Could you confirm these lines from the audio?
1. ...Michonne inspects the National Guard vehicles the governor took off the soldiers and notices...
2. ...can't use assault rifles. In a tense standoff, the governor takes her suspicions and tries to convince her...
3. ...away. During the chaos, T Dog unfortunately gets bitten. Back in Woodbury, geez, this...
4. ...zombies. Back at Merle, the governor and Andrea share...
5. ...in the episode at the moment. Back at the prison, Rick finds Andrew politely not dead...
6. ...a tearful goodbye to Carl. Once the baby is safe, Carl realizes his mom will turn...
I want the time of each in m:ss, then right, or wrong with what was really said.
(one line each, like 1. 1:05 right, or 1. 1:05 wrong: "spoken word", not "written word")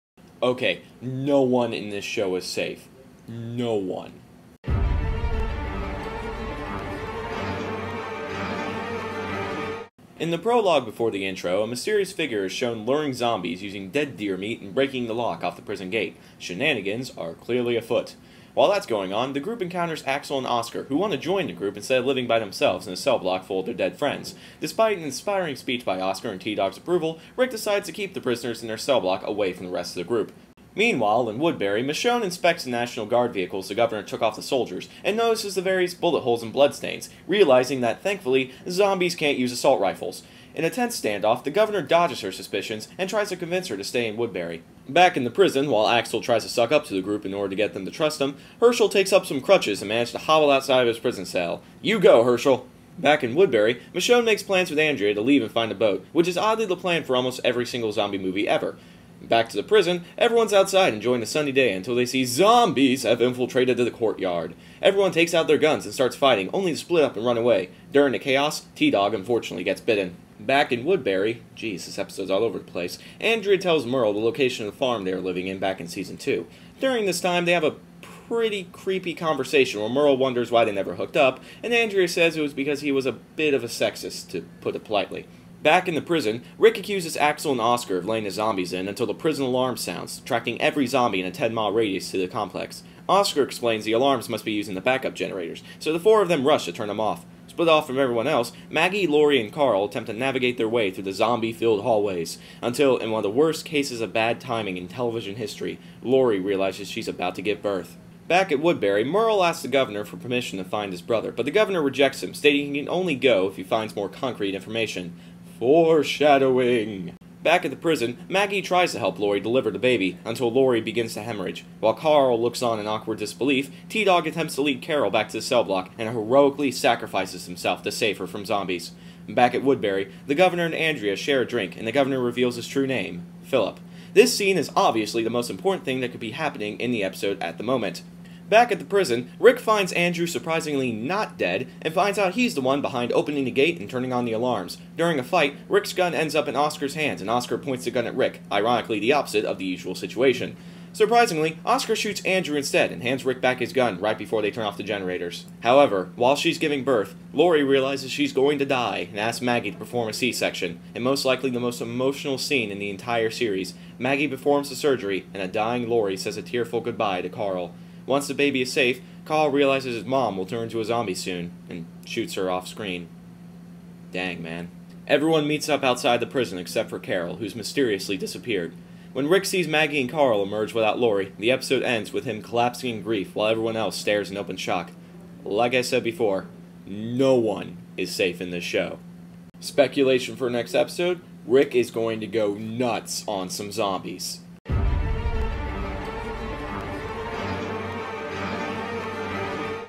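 1. 0:31 right
2. 0:39 wrong: "dodges", not "takes"
3. 1:07 right
4. 2:08 wrong: "Woodbury", not "Merle"
5. 2:16 wrong: "surprisingly", not "politely"
6. 2:46 right.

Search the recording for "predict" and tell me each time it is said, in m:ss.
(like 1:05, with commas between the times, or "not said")
not said.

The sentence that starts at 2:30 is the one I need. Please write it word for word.
Surprisingly, Oscar shoots Andrew instead and hands Rick back his gun right before they turn off the generators.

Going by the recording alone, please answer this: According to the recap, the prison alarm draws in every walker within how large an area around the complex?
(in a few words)
10 mile radius.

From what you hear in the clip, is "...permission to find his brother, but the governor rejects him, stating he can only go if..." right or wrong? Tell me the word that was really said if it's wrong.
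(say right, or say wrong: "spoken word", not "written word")
right.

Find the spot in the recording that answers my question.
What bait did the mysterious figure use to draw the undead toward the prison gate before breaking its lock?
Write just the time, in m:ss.
0:13.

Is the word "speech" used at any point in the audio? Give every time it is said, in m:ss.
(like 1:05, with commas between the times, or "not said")
0:25.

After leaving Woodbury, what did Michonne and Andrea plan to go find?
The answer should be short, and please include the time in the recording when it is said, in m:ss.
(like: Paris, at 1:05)
a boat, at 0:55.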